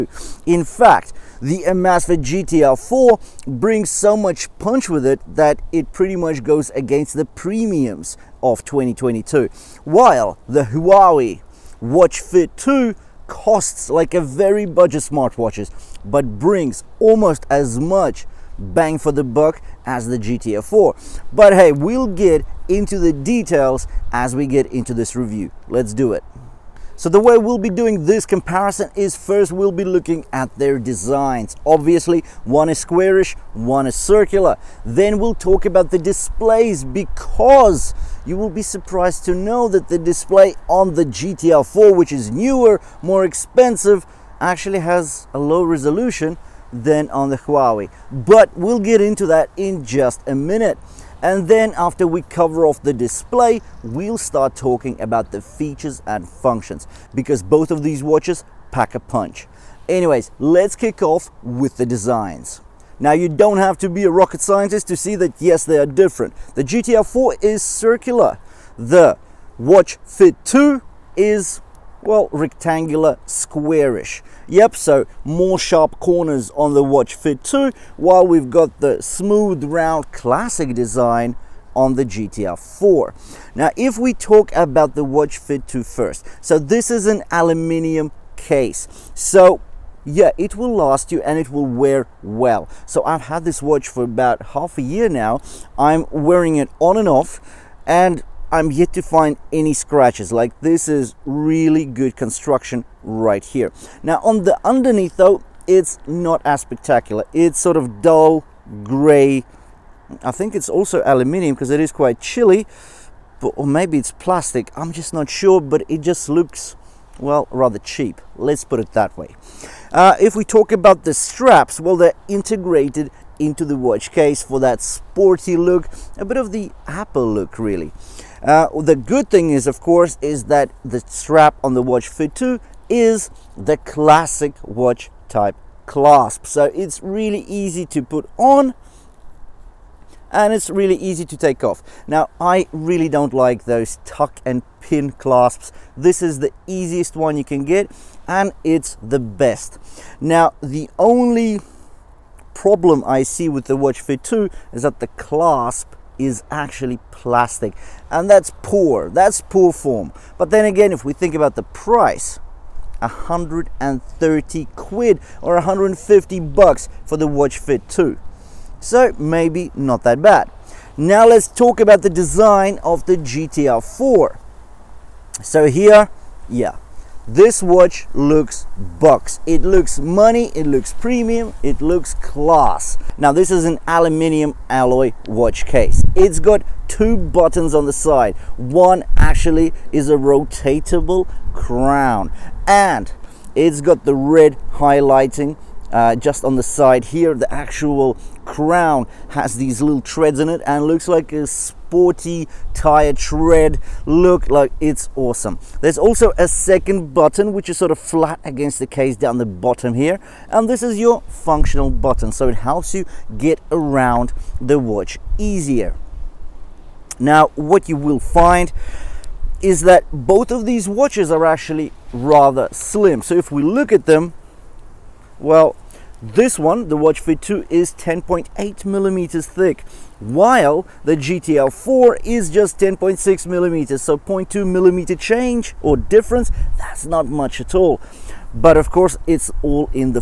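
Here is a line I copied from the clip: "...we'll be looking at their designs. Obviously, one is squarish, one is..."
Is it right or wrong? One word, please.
right.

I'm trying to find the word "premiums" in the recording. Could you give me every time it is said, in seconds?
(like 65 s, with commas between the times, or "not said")
7 s, 180 s.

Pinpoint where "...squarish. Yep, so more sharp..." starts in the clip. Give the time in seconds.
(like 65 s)
73 s.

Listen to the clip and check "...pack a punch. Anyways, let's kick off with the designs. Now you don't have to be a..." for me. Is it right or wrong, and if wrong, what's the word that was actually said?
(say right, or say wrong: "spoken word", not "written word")
right.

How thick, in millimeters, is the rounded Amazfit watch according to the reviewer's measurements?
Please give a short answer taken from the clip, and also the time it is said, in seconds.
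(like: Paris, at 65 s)
10.6 millimeters, at 232 s.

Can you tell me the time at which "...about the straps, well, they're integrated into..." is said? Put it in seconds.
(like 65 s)
120 s.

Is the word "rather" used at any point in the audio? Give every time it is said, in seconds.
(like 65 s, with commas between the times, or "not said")
117 s, 222 s.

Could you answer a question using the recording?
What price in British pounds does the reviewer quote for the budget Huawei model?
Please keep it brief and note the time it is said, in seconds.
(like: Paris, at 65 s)
130 quid, at 162 s.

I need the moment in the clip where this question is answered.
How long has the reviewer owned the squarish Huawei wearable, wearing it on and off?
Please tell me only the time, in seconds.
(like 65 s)
94 s.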